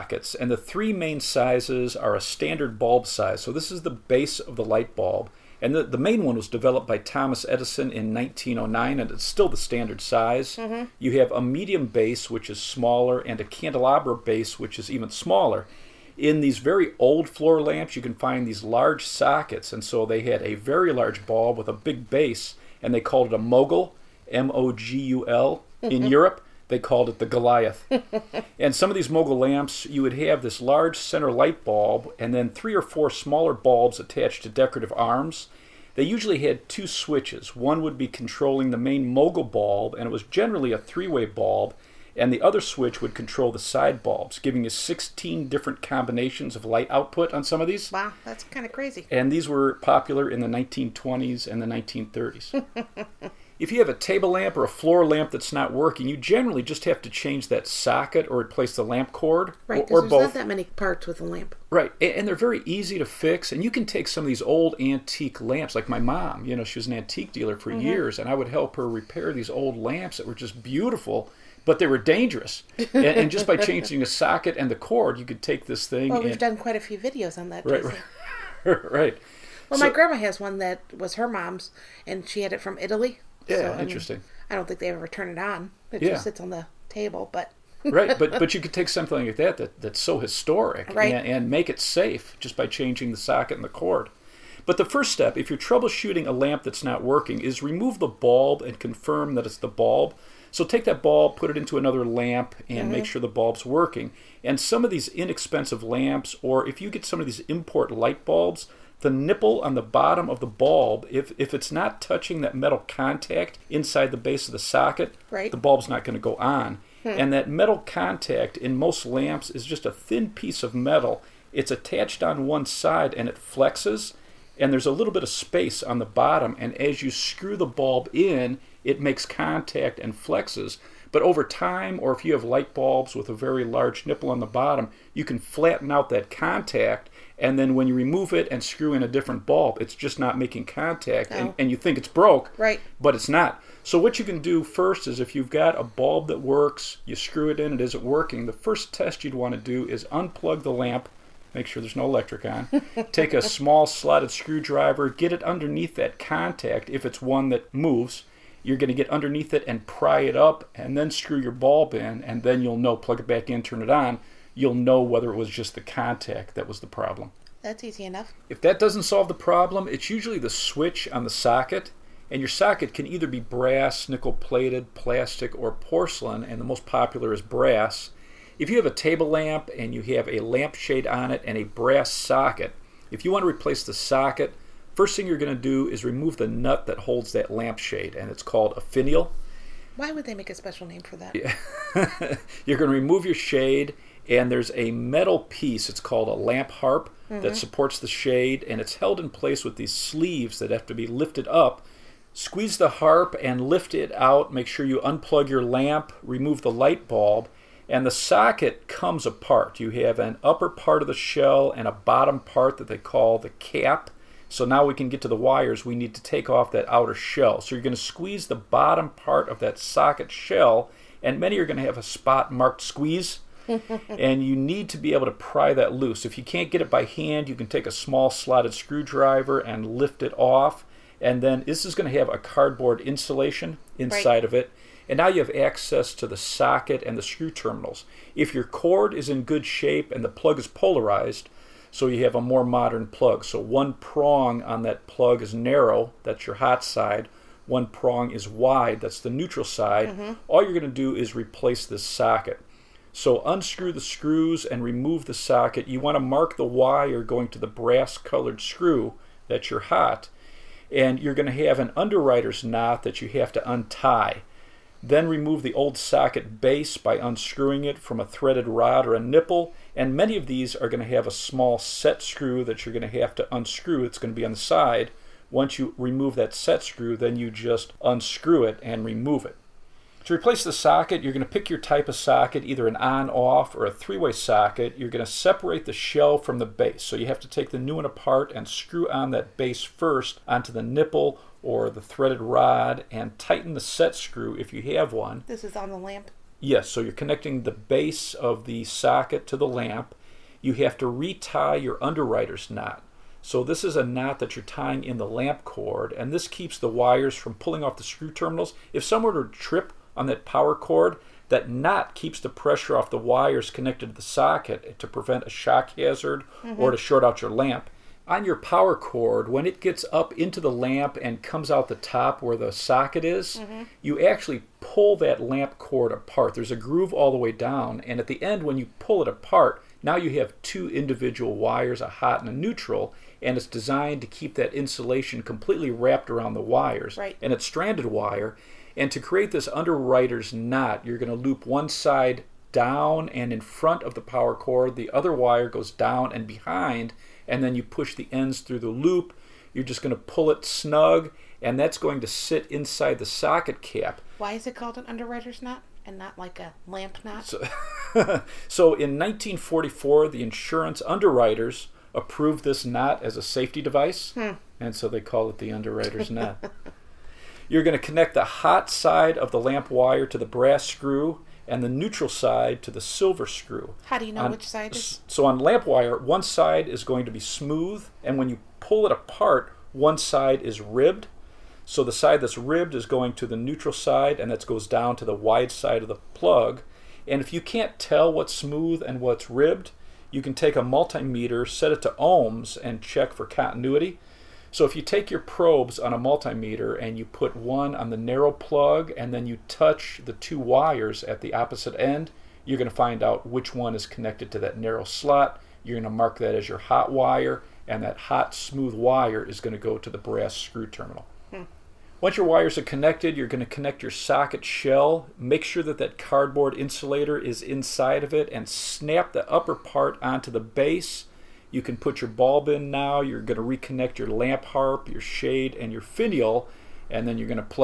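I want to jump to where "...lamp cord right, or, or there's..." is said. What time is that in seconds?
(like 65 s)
58 s.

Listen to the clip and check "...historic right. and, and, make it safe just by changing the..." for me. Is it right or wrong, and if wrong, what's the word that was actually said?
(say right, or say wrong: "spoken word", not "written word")
right.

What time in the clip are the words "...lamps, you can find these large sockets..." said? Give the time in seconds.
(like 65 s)
17 s.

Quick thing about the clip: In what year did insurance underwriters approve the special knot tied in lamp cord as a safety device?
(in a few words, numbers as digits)
1944.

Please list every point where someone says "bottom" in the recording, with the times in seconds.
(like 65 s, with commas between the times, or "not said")
109 s, 126 s, 134 s, 211 s, 218 s.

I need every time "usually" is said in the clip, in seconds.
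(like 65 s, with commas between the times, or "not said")
36 s, 170 s.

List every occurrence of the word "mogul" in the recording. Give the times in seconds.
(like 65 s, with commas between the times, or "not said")
23 s, 29 s, 39 s.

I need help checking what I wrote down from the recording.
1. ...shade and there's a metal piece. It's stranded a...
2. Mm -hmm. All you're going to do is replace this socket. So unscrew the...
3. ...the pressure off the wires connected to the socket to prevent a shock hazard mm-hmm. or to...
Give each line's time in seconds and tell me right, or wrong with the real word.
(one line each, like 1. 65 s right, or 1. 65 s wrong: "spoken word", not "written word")
1. 193 s wrong: "called", not "stranded"
2. 250 s right
3. 312 s right.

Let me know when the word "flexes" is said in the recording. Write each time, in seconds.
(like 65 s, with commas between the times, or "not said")
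123 s, 130 s.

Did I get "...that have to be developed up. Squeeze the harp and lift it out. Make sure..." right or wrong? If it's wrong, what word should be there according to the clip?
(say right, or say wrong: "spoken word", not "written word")
wrong: "lifted", not "developed".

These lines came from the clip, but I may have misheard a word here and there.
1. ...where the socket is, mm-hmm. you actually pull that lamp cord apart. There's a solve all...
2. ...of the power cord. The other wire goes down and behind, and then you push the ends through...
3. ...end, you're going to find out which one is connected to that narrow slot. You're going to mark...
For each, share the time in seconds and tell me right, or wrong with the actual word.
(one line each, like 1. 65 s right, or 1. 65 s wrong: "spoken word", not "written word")
1. 322 s wrong: "groove", not "solve"
2. 344 s right
3. 401 s right.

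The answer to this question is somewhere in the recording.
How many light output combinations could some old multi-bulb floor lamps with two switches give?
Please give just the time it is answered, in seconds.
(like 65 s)
44 s.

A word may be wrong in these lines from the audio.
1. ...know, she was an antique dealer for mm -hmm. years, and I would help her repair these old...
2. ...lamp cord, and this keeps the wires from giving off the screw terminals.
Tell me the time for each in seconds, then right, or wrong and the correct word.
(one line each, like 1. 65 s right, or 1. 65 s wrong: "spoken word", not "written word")
1. 66 s right
2. 305 s wrong: "pulling", not "giving".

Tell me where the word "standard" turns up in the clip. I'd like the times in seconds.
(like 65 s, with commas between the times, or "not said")
2 s, 9 s.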